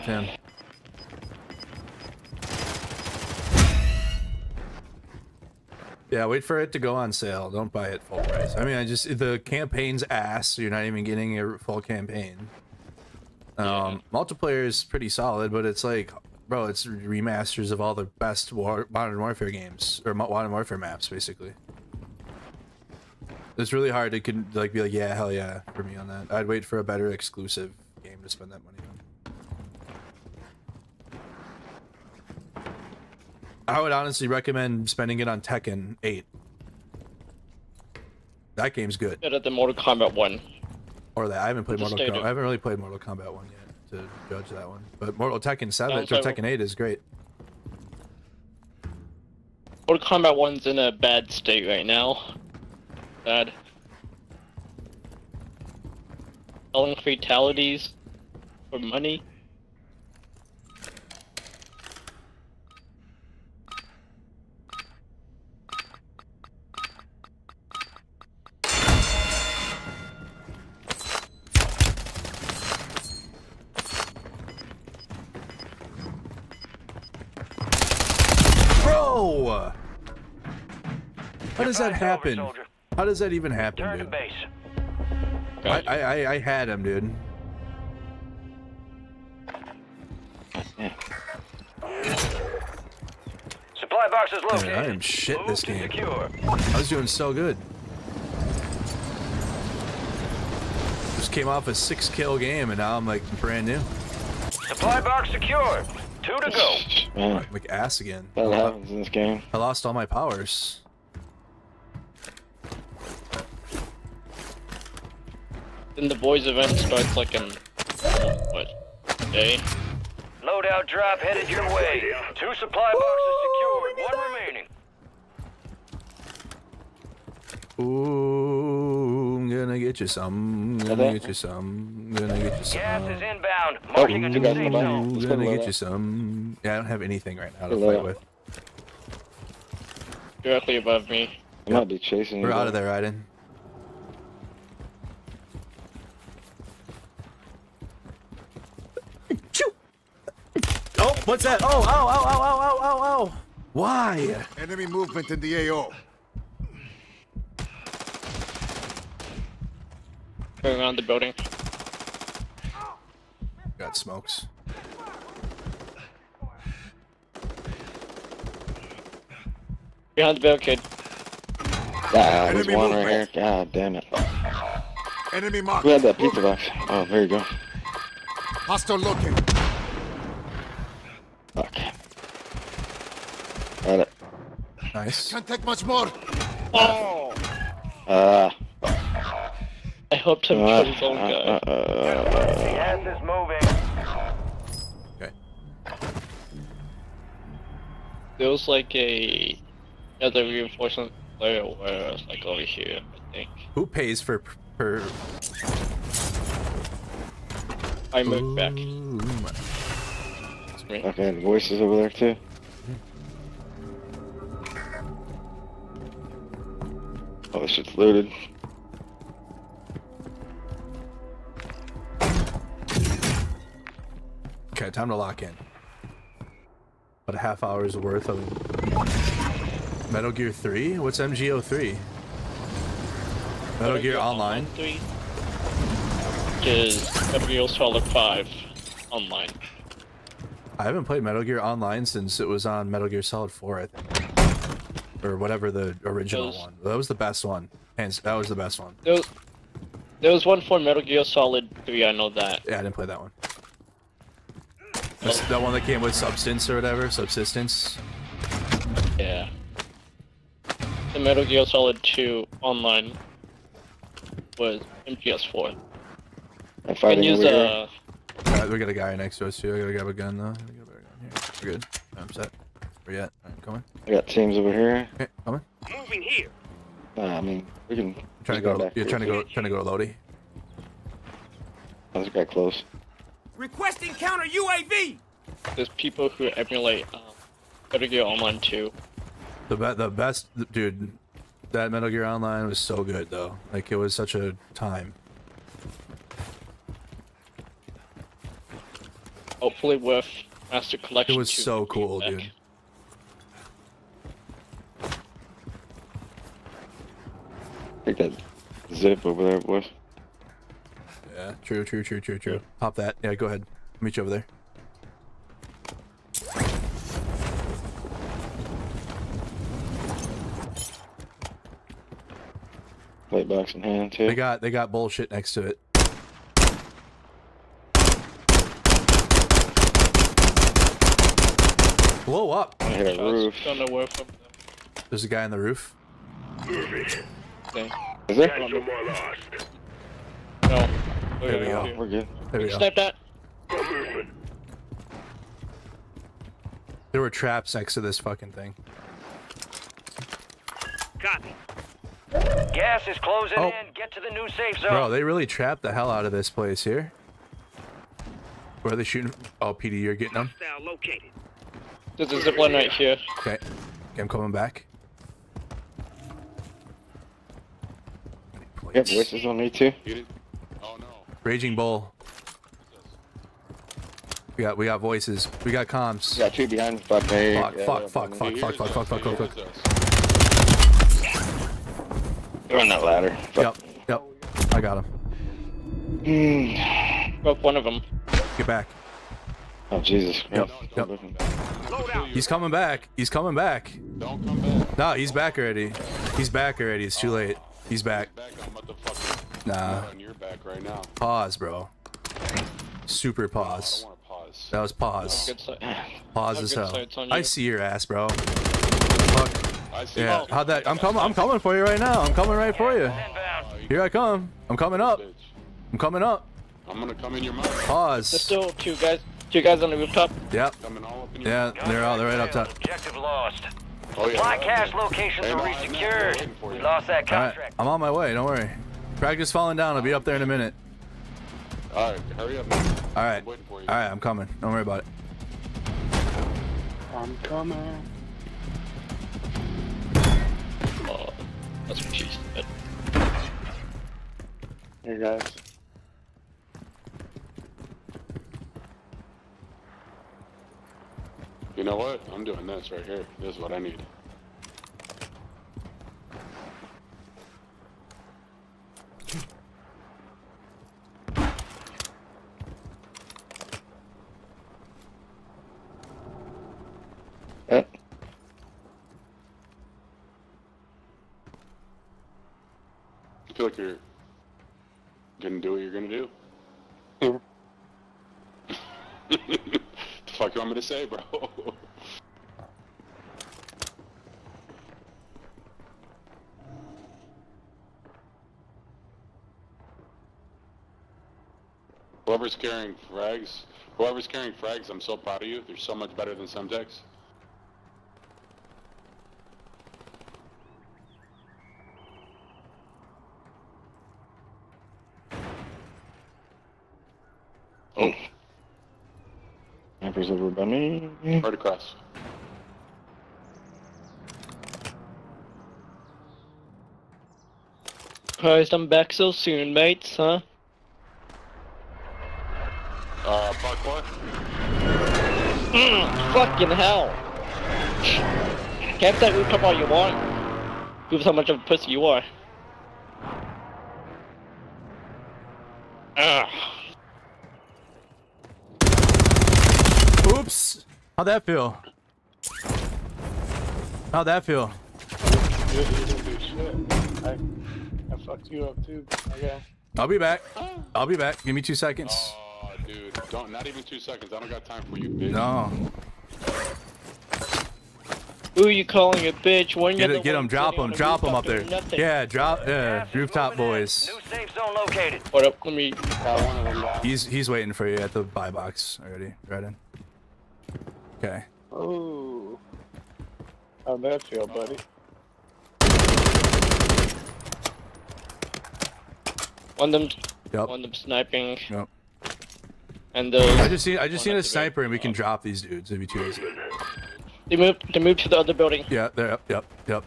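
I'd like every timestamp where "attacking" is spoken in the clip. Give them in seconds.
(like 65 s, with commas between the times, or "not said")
not said.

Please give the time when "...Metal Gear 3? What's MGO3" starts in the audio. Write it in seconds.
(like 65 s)
230 s.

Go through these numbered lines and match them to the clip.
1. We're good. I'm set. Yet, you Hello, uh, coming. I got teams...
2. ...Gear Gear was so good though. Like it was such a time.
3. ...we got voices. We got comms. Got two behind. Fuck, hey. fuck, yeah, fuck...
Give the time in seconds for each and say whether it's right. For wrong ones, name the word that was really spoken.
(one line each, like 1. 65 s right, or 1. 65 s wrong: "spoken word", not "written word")
1. 271 s wrong: "Right", not "Hello"
2. 292 s wrong: "Online", not "Gear"
3. 374 s right.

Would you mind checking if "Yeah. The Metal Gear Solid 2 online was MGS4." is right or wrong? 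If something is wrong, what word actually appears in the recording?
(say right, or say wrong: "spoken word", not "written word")
right.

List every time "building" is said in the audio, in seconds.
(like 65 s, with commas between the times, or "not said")
161 s, 588 s.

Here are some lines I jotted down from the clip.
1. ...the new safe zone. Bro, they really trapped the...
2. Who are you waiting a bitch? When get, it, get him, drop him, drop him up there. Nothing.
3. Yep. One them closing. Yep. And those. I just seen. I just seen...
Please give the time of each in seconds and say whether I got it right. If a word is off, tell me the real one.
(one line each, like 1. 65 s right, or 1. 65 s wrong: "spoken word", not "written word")
1. 354 s right
2. 558 s wrong: "calling", not "waiting"
3. 580 s wrong: "sniping", not "closing".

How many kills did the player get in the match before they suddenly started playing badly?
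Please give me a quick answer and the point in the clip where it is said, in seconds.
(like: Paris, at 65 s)
6, at 101 s.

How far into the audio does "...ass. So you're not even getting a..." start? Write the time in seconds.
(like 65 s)
10 s.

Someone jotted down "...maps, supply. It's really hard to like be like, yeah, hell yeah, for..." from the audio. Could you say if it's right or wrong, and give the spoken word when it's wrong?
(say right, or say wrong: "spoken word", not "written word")
wrong: "basically", not "supply".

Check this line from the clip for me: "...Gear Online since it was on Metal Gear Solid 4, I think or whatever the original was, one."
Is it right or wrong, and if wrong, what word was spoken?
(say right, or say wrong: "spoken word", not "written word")
right.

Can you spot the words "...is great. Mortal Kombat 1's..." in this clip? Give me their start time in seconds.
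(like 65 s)
46 s.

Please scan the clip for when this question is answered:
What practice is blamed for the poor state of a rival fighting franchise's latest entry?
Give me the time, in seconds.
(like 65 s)
56 s.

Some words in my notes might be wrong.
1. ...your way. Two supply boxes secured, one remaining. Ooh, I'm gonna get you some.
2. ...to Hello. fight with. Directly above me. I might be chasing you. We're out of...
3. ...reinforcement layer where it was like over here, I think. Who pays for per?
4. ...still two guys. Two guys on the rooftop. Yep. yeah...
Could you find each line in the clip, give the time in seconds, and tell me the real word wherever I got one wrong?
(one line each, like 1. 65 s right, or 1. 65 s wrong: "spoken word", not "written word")
1. 121 s right
2. 137 s right
3. 200 s right
4. 418 s right.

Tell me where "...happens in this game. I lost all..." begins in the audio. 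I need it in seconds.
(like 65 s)
108 s.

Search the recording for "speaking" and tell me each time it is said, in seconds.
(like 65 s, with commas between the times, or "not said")
not said.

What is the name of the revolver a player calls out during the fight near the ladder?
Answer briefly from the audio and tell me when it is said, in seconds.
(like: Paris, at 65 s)
Raging Bull, at 371 s.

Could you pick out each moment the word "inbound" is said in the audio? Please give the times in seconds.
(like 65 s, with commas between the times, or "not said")
133 s.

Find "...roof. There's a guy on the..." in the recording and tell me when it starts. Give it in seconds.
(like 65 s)
333 s.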